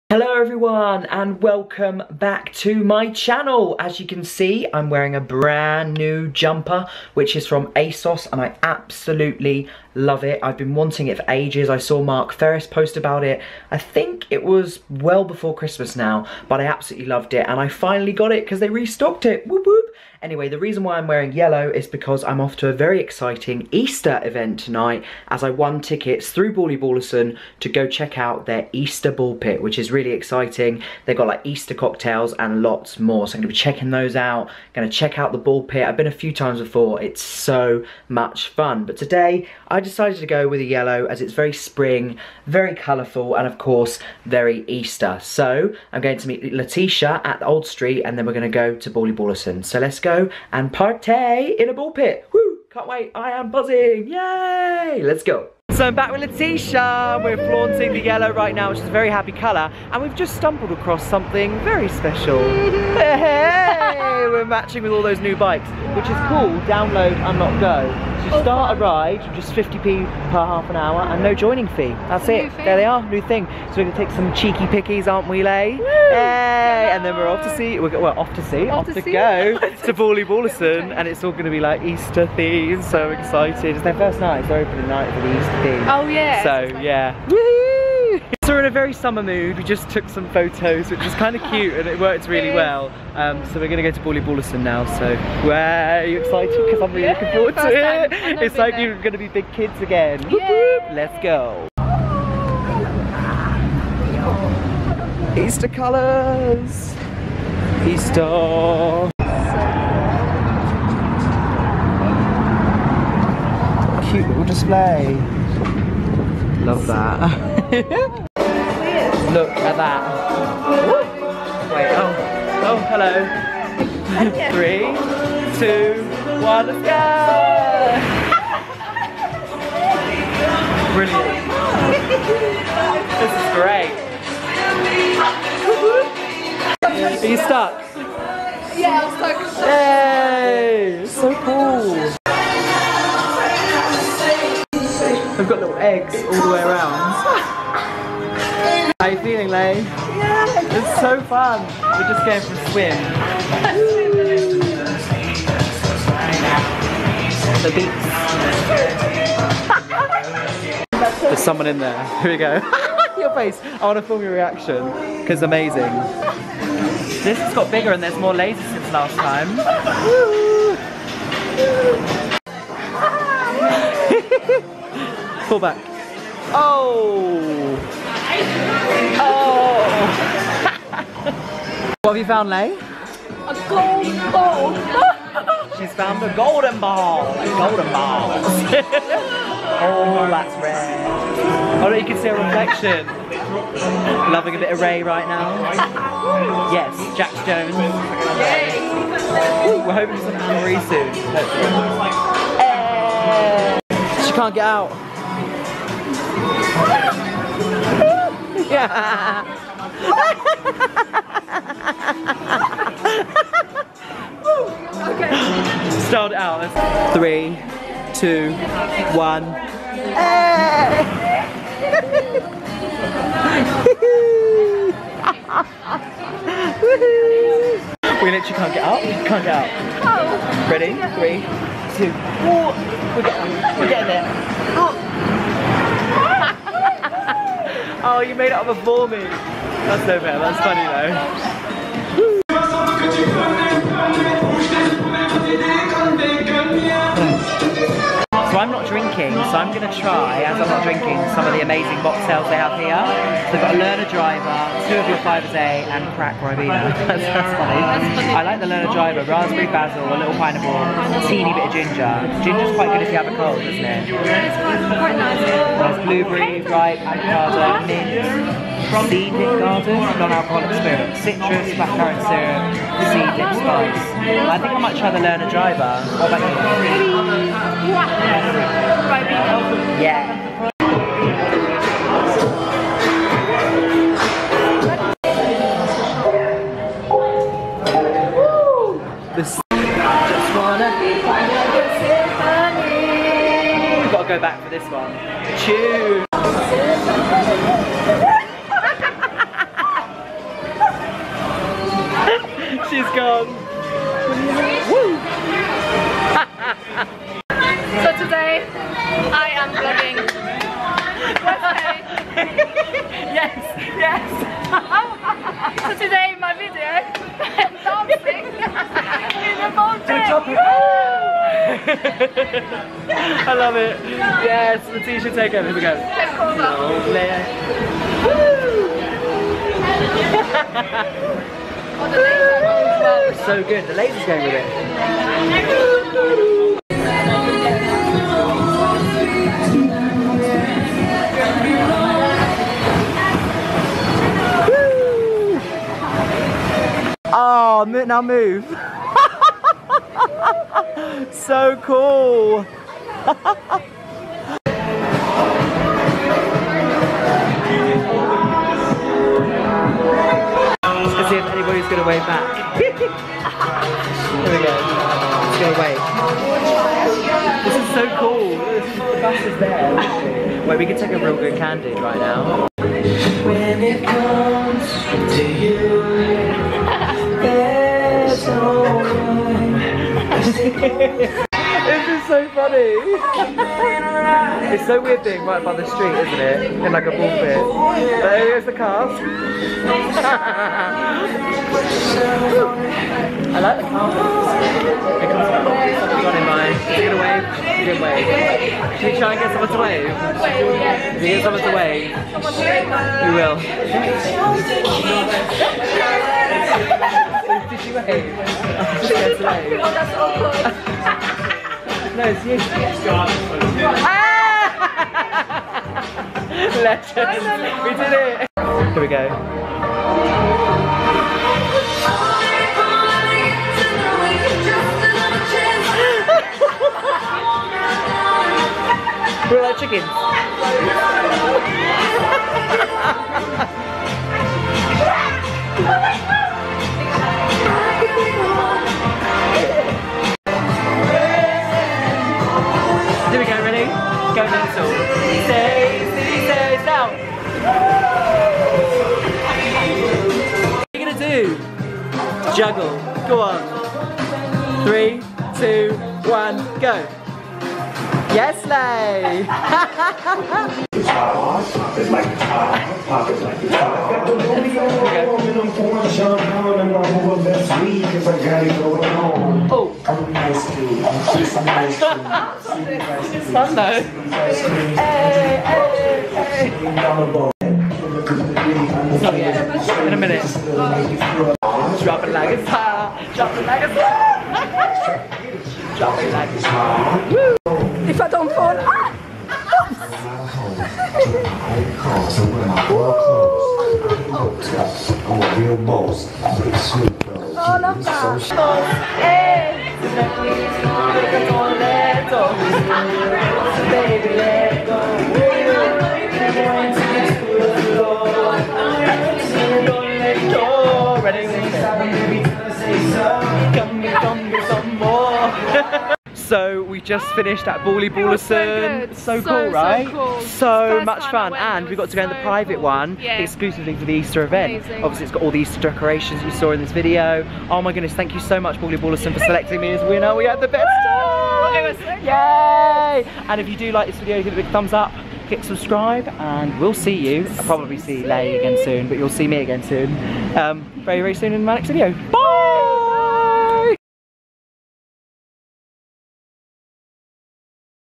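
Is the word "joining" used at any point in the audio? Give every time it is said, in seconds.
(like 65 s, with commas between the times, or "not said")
71 s.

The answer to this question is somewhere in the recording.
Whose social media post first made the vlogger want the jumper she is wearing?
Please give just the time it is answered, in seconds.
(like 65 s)
12 s.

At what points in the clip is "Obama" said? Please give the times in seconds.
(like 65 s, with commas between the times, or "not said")
not said.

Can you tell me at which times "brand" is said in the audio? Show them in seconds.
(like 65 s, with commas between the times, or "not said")
5 s.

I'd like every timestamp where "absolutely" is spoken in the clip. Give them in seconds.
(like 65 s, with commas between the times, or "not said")
8 s, 16 s.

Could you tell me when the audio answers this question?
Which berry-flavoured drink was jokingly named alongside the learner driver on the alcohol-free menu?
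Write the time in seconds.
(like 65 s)
256 s.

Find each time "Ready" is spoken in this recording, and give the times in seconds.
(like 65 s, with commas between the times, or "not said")
230 s.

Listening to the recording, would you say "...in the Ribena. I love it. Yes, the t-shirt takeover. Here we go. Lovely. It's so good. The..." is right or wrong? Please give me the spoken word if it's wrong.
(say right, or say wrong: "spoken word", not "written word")
wrong: "Baltic", not "Ribena".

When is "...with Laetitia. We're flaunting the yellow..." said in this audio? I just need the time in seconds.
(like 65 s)
56 s.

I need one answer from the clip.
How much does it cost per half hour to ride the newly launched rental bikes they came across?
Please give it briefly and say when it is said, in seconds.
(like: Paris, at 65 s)
50p, at 69 s.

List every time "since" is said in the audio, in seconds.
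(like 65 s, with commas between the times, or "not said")
168 s.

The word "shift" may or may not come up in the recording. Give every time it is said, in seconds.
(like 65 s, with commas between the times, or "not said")
not said.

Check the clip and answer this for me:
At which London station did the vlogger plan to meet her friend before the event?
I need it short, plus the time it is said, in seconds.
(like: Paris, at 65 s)
Old Street, at 47 s.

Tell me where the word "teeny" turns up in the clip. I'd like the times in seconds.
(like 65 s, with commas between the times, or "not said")
261 s.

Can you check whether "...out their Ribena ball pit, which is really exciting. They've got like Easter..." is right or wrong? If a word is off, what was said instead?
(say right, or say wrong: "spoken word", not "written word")
wrong: "Easter", not "Ribena".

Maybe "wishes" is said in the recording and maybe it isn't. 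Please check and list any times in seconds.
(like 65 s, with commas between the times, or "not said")
not said.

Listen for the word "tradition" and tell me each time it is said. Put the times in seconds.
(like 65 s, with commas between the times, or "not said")
not said.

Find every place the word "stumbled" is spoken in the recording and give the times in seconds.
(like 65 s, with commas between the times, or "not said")
60 s.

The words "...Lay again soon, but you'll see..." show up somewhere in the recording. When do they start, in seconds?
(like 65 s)
538 s.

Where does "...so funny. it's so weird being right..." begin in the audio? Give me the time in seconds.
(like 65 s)
382 s.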